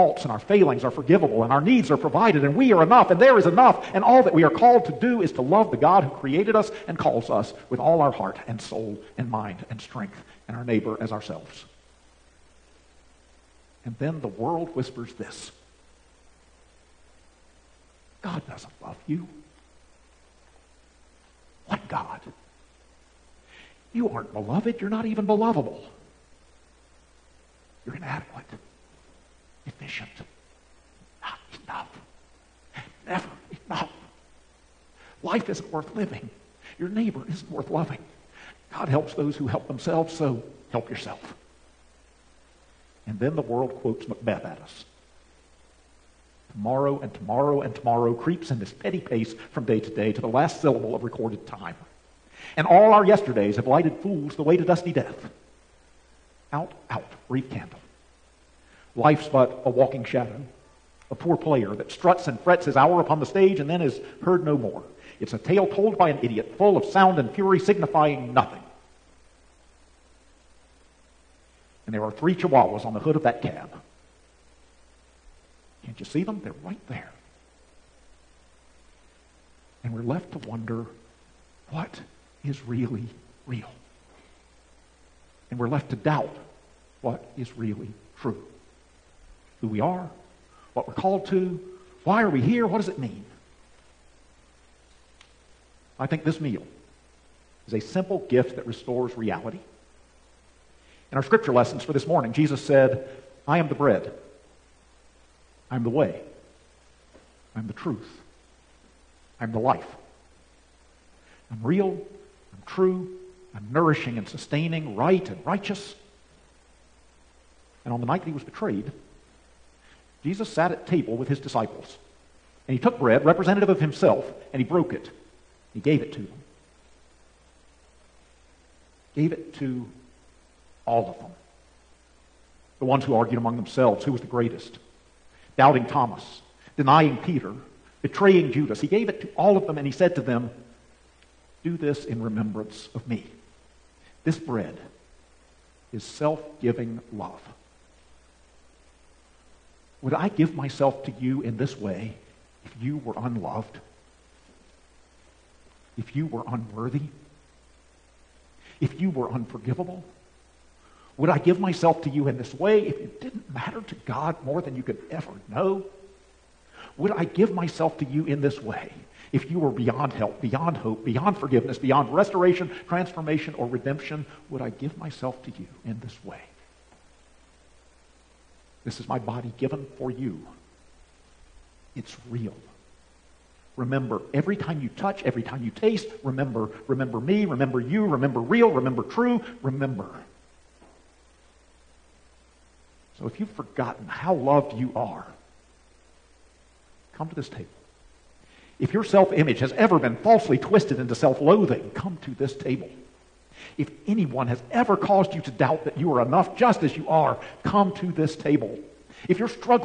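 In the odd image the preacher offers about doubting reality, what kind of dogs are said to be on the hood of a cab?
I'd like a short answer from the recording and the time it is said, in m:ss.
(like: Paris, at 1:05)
Chihuahuas, at 1:12.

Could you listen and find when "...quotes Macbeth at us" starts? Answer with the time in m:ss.
0:43.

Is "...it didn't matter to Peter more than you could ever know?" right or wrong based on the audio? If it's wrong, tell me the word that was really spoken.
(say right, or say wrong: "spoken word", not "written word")
wrong: "God", not "Peter".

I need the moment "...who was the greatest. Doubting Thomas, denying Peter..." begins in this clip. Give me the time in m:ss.
2:14.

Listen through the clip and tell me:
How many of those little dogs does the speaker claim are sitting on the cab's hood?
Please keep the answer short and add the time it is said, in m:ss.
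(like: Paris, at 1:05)
3, at 1:12.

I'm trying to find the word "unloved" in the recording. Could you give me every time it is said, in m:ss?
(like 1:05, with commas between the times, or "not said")
2:33.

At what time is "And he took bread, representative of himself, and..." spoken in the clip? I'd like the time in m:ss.
2:02.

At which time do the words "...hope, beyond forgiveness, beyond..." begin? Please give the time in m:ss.
2:50.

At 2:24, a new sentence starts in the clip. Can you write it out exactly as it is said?
This bread is self giving love.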